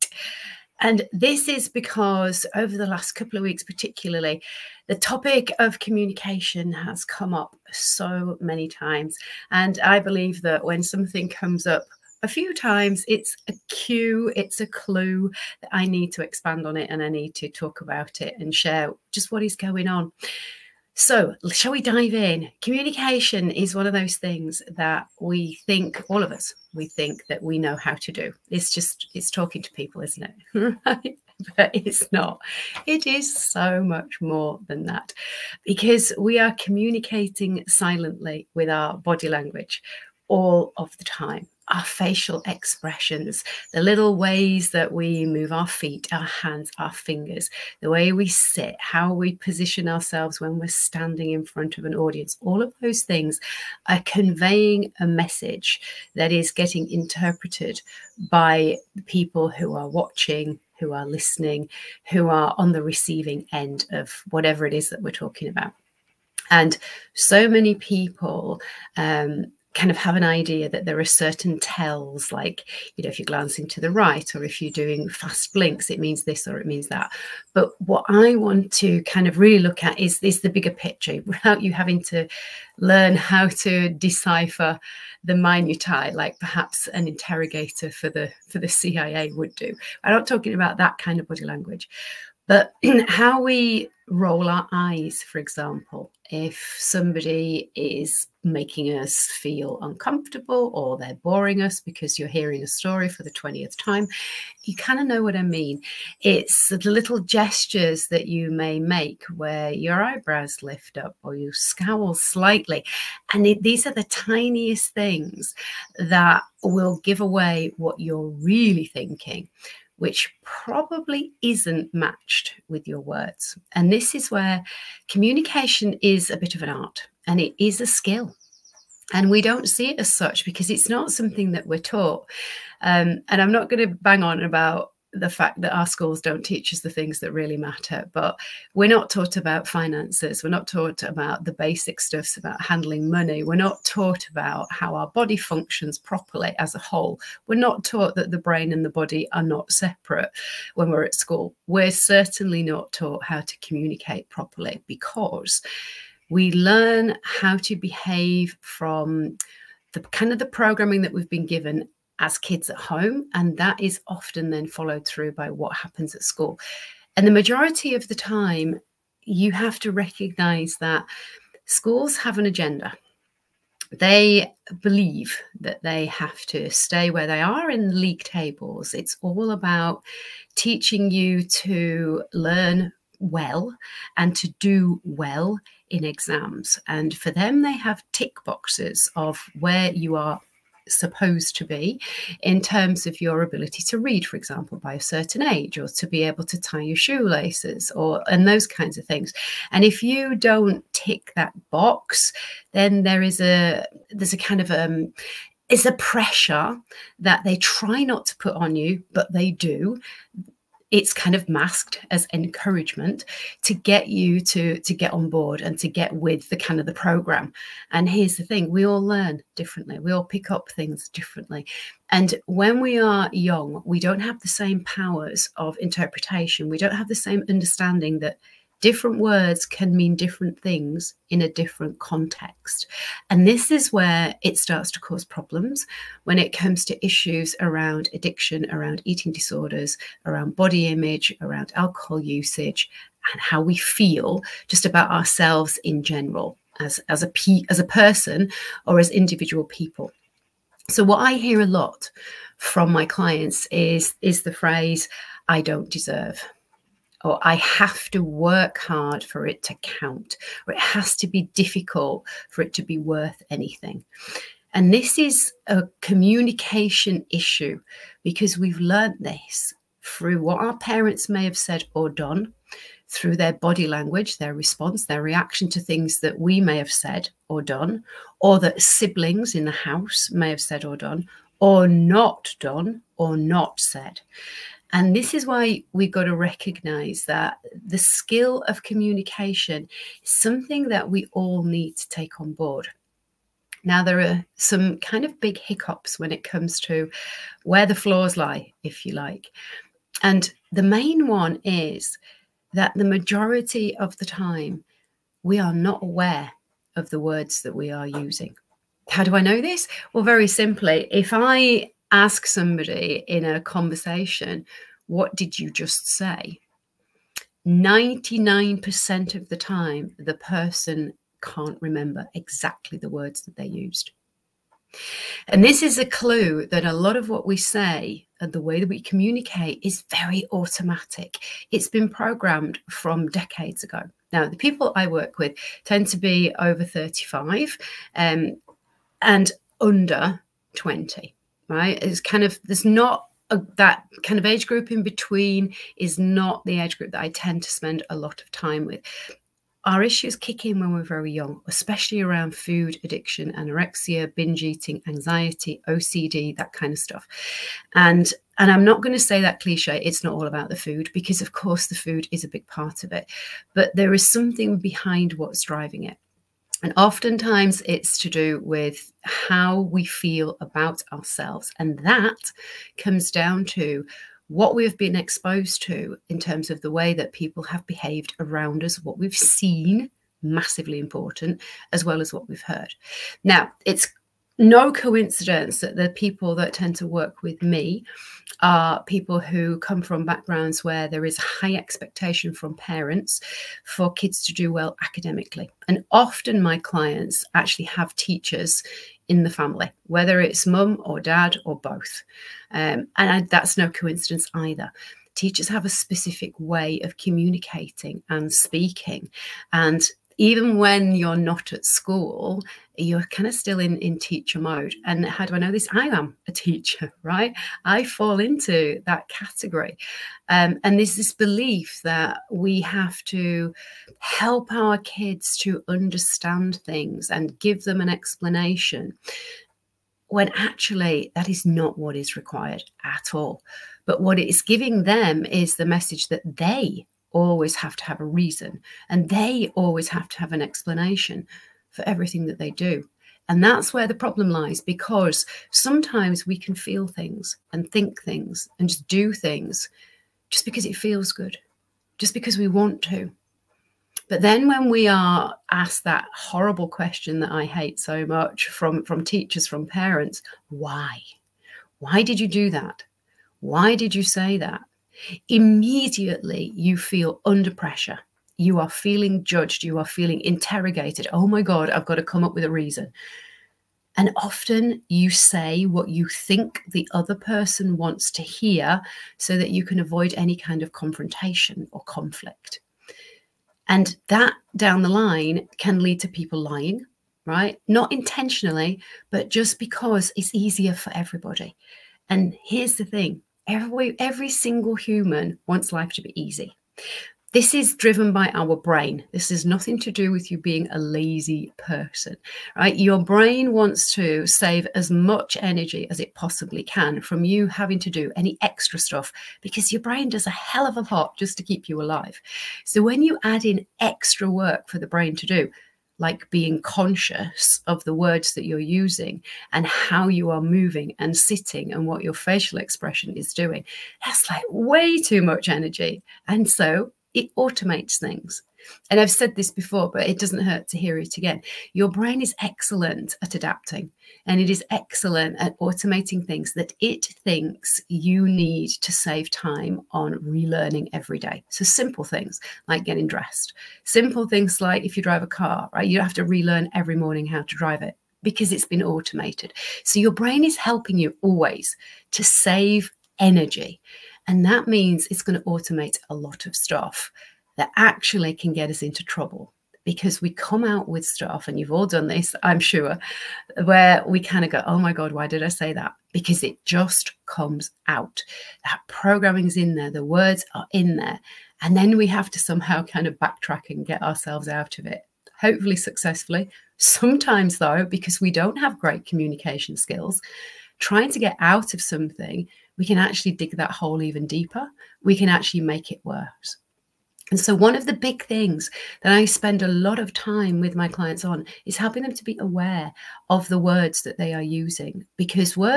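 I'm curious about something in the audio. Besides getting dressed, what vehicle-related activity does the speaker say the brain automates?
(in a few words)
drive a car.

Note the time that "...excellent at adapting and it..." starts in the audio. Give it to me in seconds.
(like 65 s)
532 s.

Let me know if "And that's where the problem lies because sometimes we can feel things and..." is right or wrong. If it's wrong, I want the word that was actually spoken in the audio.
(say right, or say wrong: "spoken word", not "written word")
right.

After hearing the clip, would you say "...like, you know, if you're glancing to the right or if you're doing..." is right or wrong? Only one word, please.
right.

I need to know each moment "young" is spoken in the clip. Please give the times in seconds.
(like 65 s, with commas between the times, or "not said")
223 s, 351 s.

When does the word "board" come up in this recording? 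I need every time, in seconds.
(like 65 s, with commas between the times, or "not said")
215 s, 292 s.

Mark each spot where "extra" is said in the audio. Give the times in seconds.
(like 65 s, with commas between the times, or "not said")
508 s, 513 s.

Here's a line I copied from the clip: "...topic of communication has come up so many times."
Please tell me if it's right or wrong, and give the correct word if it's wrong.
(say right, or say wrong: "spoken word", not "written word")
right.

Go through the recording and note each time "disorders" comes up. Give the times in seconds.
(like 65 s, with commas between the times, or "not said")
239 s.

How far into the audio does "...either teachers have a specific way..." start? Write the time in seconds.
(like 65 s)
404 s.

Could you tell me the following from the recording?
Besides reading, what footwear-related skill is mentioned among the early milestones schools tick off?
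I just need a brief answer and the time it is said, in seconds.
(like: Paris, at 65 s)
tie your shoelaces, at 196 s.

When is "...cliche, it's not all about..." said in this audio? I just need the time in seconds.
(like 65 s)
359 s.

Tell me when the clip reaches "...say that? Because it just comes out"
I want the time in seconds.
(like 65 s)
565 s.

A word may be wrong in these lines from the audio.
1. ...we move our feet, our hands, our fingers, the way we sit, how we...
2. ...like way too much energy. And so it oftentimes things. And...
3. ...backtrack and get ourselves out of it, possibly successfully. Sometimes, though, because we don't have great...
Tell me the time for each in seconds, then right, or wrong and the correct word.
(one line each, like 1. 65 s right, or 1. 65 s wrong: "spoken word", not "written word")
1. 44 s right
2. 524 s wrong: "automates", not "oftentimes"
3. 573 s wrong: "hopefully", not "possibly".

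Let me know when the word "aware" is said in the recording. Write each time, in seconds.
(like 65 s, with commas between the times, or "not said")
306 s, 592 s.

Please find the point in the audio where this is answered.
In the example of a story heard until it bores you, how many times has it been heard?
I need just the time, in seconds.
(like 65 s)
103 s.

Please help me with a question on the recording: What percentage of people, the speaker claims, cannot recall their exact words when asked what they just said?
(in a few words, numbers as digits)
99%.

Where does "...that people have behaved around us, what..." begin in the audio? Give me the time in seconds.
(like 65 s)
377 s.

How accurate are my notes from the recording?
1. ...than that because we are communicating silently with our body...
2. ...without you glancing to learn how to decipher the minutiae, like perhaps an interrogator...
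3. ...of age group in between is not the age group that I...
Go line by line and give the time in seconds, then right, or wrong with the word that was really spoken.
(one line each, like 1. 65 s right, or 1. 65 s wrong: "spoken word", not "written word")
1. 34 s right
2. 81 s wrong: "having", not "glancing"
3. 344 s right.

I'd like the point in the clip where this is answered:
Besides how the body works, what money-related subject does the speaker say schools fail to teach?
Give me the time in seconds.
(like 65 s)
139 s.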